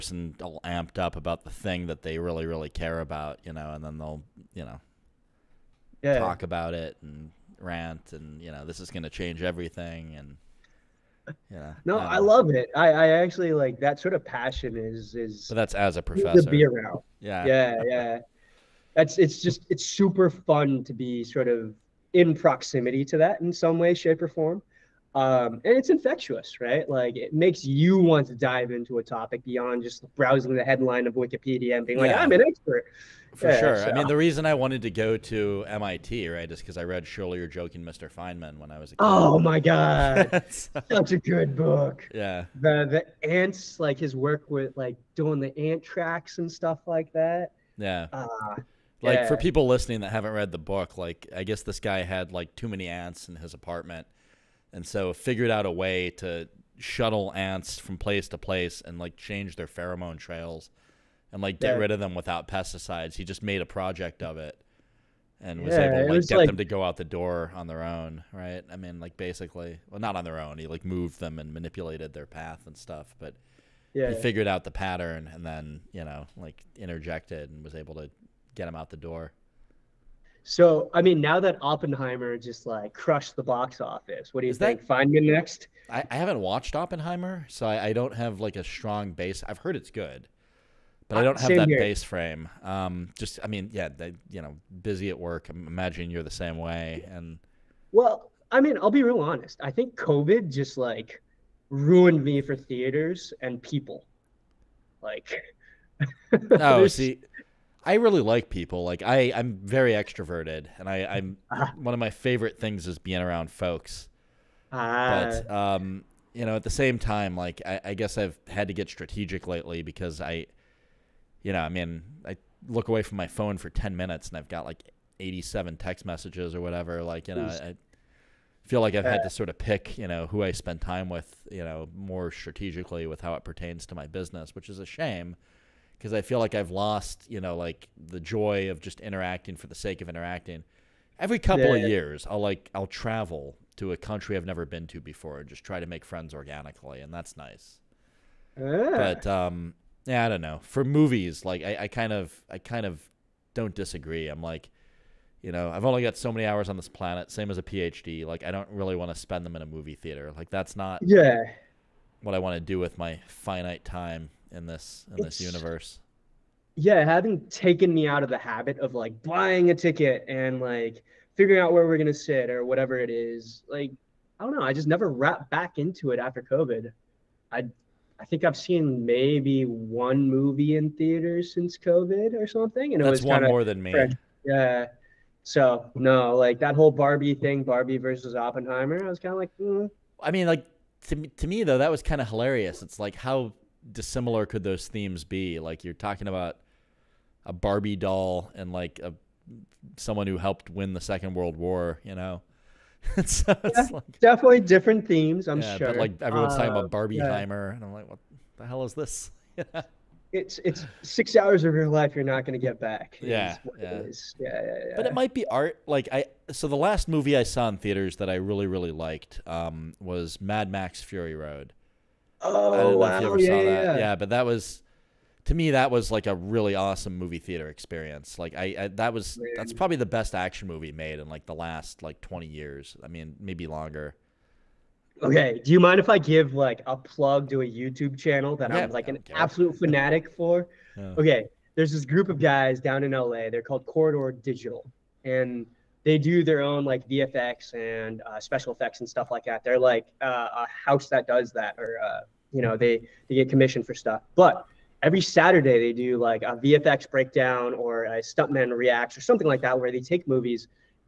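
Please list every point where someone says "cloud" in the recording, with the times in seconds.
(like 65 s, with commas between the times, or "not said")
not said.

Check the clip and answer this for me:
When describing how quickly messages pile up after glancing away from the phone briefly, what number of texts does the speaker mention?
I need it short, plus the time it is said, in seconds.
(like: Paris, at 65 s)
87, at 125 s.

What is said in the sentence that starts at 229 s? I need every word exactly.
that's probably the best action movie made in like the last like 20 years.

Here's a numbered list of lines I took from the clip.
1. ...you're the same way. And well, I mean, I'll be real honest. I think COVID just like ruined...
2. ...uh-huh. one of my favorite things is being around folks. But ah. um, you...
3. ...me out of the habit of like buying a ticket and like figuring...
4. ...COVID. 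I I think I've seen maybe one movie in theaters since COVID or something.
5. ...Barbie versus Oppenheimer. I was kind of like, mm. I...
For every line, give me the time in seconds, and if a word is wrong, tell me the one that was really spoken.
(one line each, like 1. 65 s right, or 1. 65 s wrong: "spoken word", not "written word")
1. 96 s right
2. 111 s right
3. 167 s right
4. 176 s right
5. 187 s right.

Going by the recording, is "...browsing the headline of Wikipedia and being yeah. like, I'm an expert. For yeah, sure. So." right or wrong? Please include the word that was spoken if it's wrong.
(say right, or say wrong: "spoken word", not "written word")
right.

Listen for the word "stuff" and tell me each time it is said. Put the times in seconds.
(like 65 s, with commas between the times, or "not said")
46 s, 72 s, 249 s, 253 s.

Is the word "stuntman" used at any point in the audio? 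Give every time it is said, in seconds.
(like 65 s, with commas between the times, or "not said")
258 s.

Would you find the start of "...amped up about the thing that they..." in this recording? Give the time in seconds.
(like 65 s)
0 s.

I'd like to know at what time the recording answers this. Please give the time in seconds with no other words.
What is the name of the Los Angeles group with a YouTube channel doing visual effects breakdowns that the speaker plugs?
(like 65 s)
243 s.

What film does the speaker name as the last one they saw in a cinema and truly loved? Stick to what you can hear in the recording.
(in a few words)
Mad Max Fury Road.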